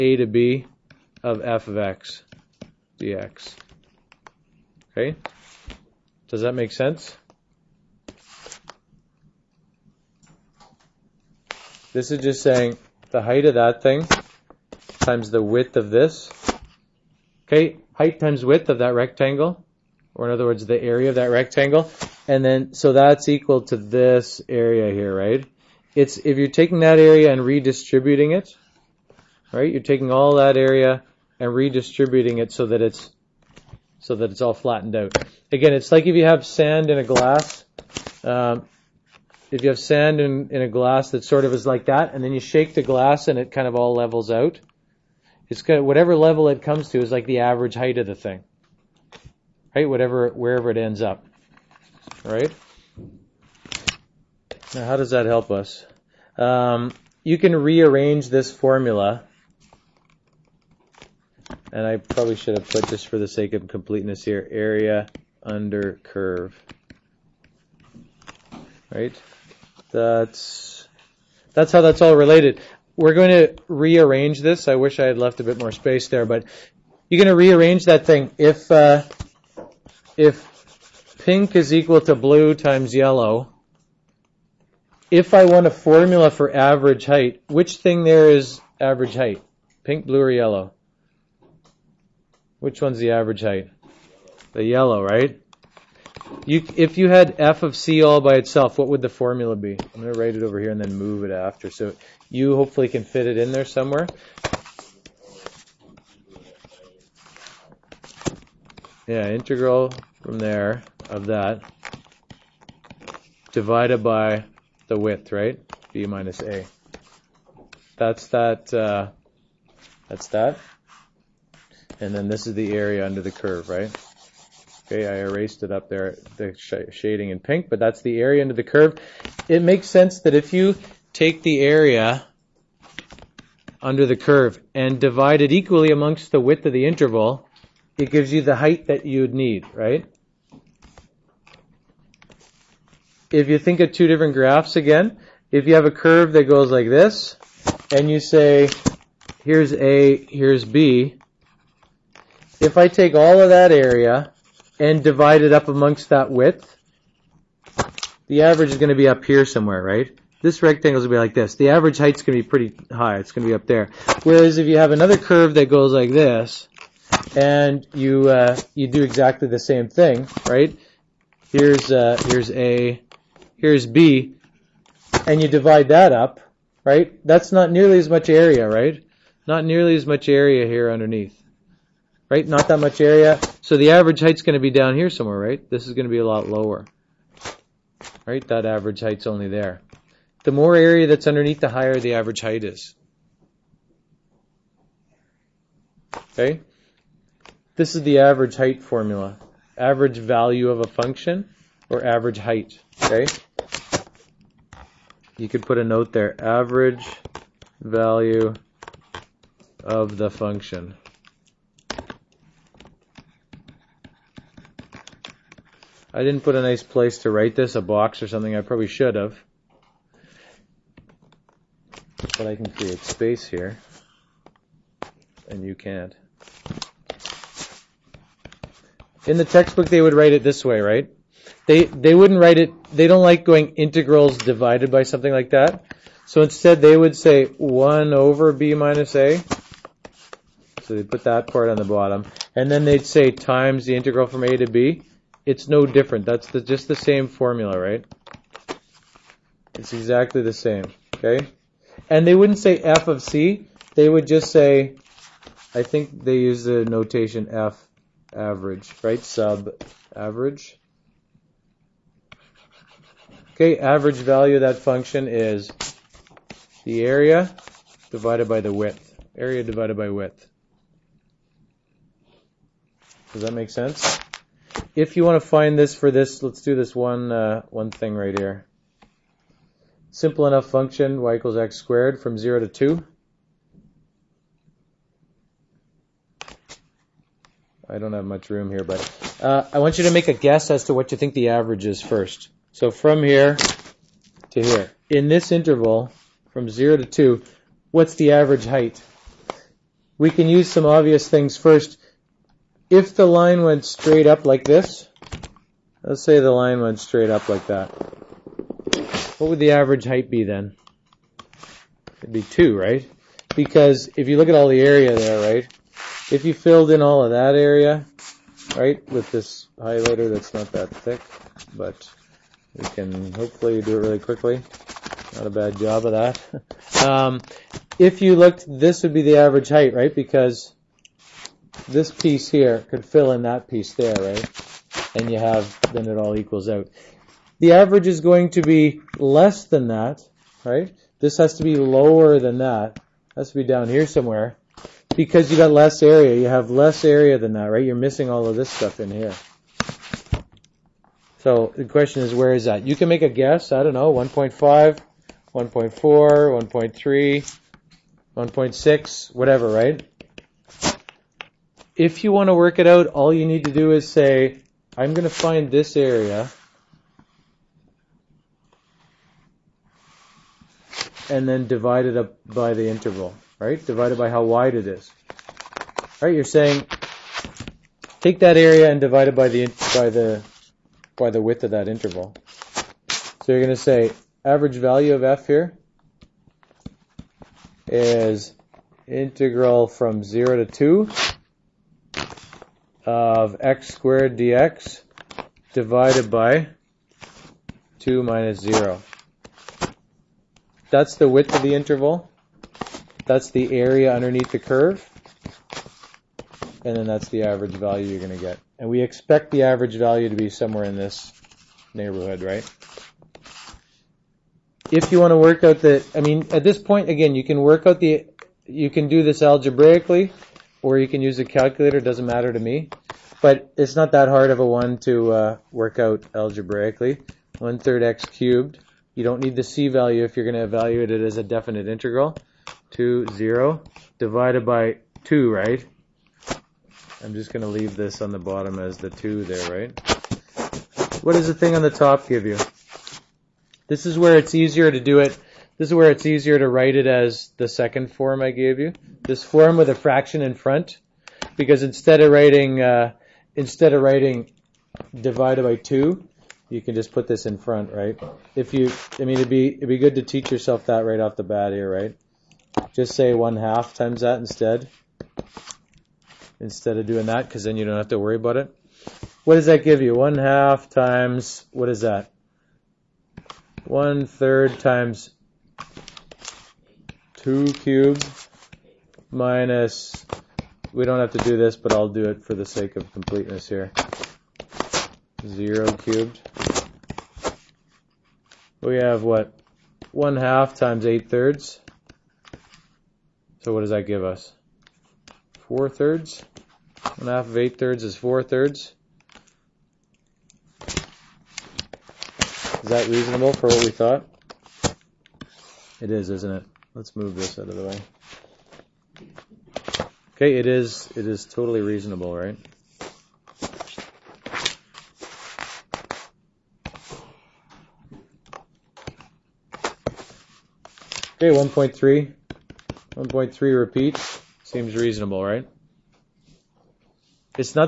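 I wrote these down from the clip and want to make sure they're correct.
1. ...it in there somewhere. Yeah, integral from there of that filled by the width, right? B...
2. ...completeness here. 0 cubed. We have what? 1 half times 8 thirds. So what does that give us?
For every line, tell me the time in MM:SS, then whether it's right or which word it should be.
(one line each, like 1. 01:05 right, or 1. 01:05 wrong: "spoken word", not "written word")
1. 01:43 wrong: "divided", not "filled"
2. 08:03 right.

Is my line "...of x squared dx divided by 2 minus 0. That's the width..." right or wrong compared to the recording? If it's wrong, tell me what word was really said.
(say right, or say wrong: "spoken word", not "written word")
right.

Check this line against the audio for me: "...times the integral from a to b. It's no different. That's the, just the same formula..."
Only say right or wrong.
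right.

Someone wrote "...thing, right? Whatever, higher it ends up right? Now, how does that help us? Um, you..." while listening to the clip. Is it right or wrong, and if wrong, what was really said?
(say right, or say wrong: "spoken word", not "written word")
wrong: "wherever", not "higher".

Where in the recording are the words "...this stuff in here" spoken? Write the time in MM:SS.
05:48.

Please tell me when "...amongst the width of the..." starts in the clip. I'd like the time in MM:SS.
02:15.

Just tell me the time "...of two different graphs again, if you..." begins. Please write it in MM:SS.
02:23.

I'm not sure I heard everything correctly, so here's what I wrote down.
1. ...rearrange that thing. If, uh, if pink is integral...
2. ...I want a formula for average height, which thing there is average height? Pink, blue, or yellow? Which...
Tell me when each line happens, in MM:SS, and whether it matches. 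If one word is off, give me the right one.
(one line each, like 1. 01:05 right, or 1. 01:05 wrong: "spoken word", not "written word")
1. 01:17 wrong: "equal", not "integral"
2. 01:25 right.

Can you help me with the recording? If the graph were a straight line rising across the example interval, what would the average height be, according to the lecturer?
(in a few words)
2.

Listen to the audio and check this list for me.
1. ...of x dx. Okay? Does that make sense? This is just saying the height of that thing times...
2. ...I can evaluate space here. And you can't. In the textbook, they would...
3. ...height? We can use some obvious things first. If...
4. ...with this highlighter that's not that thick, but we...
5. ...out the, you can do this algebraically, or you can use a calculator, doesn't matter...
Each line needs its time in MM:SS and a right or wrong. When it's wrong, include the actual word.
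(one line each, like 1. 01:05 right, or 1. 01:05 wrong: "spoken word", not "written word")
1. 00:01 right
2. 03:42 wrong: "create", not "evaluate"
3. 04:58 right
4. 05:19 right
5. 06:57 right.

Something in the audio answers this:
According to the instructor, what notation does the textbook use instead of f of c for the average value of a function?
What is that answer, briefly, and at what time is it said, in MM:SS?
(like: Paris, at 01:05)
f average, at 04:17.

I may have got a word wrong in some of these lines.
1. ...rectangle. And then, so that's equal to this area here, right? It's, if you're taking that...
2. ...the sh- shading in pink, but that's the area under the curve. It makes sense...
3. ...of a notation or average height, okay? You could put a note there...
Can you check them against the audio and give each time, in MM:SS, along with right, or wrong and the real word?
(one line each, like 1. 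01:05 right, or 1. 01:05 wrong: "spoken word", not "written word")
1. 00:21 right
2. 02:06 right
3. 03:20 wrong: "function", not "notation".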